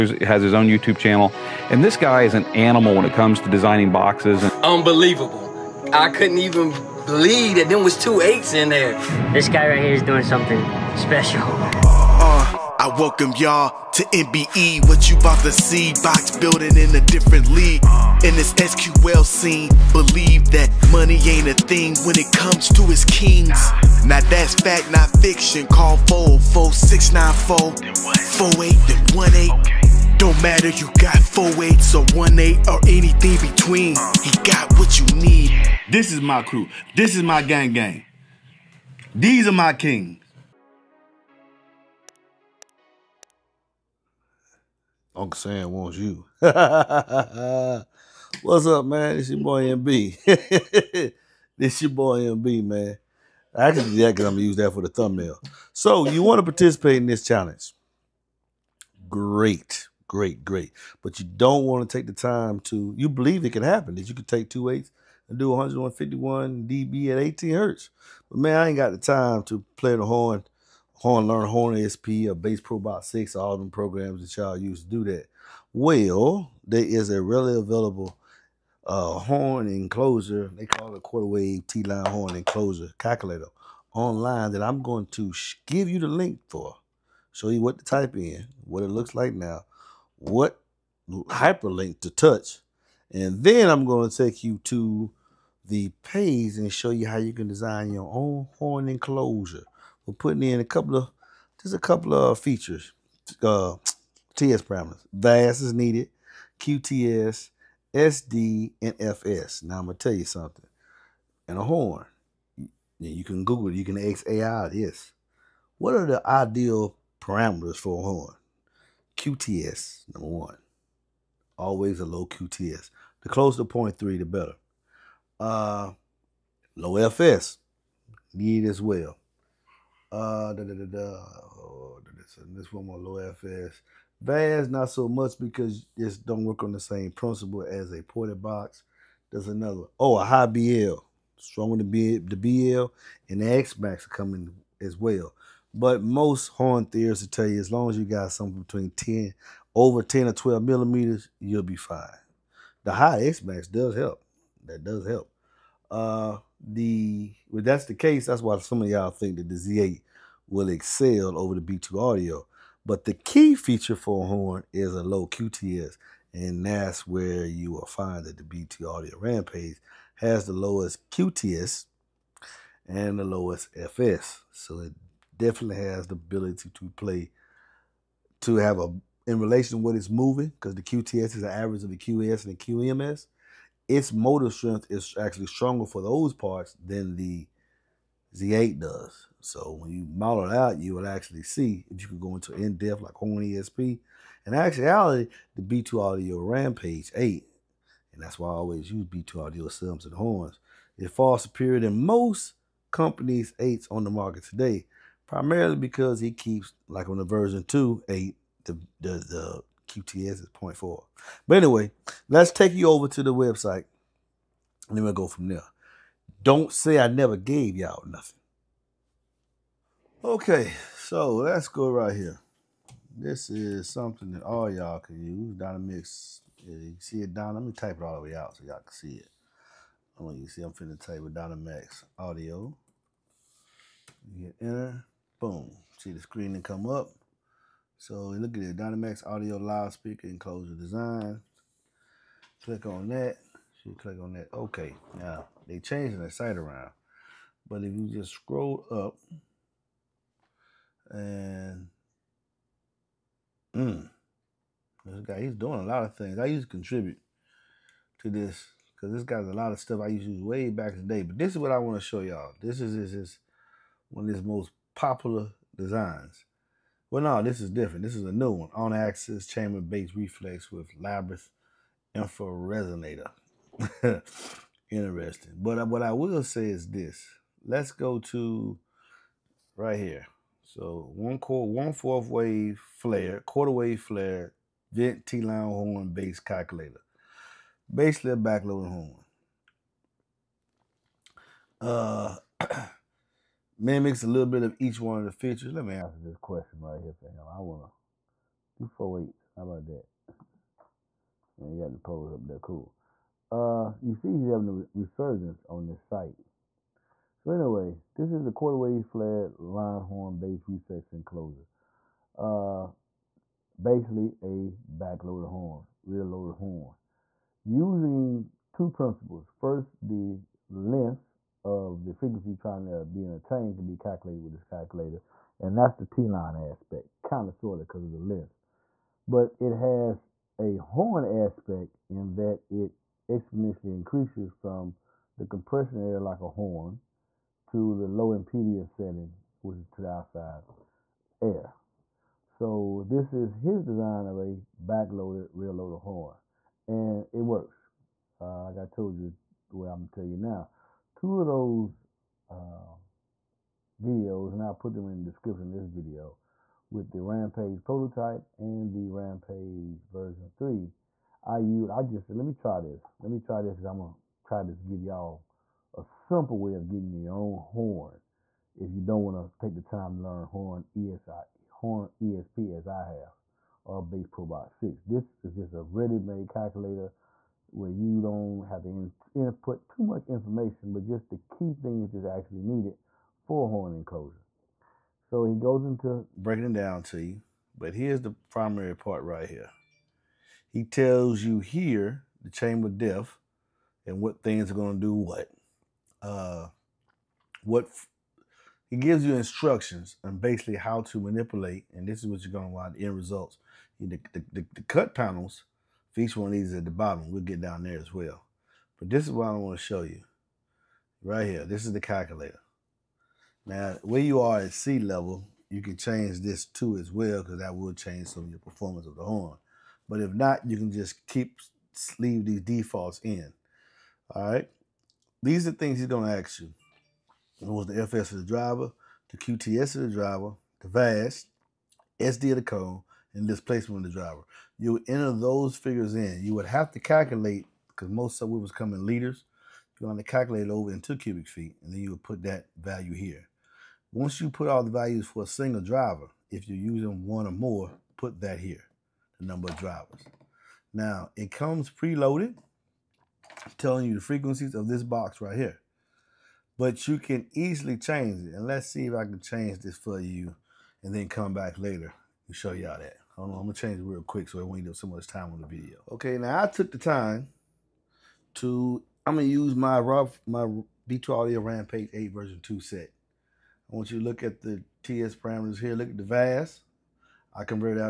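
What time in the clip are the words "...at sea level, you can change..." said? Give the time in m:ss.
6:54.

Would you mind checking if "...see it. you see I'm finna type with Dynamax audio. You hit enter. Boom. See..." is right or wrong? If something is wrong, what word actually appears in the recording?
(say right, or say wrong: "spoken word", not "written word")
right.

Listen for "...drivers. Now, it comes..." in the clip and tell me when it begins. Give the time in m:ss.
7:29.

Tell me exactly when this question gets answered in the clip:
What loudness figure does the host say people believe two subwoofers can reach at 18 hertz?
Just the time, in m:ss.
1:05.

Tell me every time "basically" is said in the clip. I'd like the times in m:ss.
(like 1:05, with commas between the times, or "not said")
4:47, 5:13, 6:40.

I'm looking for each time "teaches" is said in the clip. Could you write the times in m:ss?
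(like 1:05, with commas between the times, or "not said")
not said.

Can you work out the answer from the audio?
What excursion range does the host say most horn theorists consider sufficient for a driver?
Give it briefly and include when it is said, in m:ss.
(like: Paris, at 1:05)
10 or 12 millimeters, at 2:30.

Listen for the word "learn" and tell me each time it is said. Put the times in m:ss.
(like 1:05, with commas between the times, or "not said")
1:11, 6:10.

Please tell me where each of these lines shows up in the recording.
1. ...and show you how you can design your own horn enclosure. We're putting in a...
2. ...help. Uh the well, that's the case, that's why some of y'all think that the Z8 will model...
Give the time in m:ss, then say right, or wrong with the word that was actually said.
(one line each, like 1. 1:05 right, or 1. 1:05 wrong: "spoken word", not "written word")
1. 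1:36 right
2. 2:35 wrong: "excel", not "model".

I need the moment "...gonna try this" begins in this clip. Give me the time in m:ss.
6:03.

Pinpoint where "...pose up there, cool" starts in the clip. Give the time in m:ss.
5:01.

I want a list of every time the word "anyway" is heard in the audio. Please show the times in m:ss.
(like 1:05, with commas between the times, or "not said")
3:31, 5:07.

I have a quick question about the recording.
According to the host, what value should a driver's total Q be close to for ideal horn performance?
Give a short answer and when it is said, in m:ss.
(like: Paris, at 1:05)
0.3, at 2:03.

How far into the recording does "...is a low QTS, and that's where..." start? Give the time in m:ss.
2:44.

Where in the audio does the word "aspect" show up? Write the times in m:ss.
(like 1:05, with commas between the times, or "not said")
5:26, 5:31.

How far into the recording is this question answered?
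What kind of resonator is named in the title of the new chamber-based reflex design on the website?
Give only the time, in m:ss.
4:30.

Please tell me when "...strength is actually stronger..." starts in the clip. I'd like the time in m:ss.
3:04.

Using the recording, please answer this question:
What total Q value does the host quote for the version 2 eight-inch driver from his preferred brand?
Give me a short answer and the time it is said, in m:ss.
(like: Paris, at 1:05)
0.4, at 3:30.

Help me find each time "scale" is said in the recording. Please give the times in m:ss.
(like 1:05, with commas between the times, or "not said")
not said.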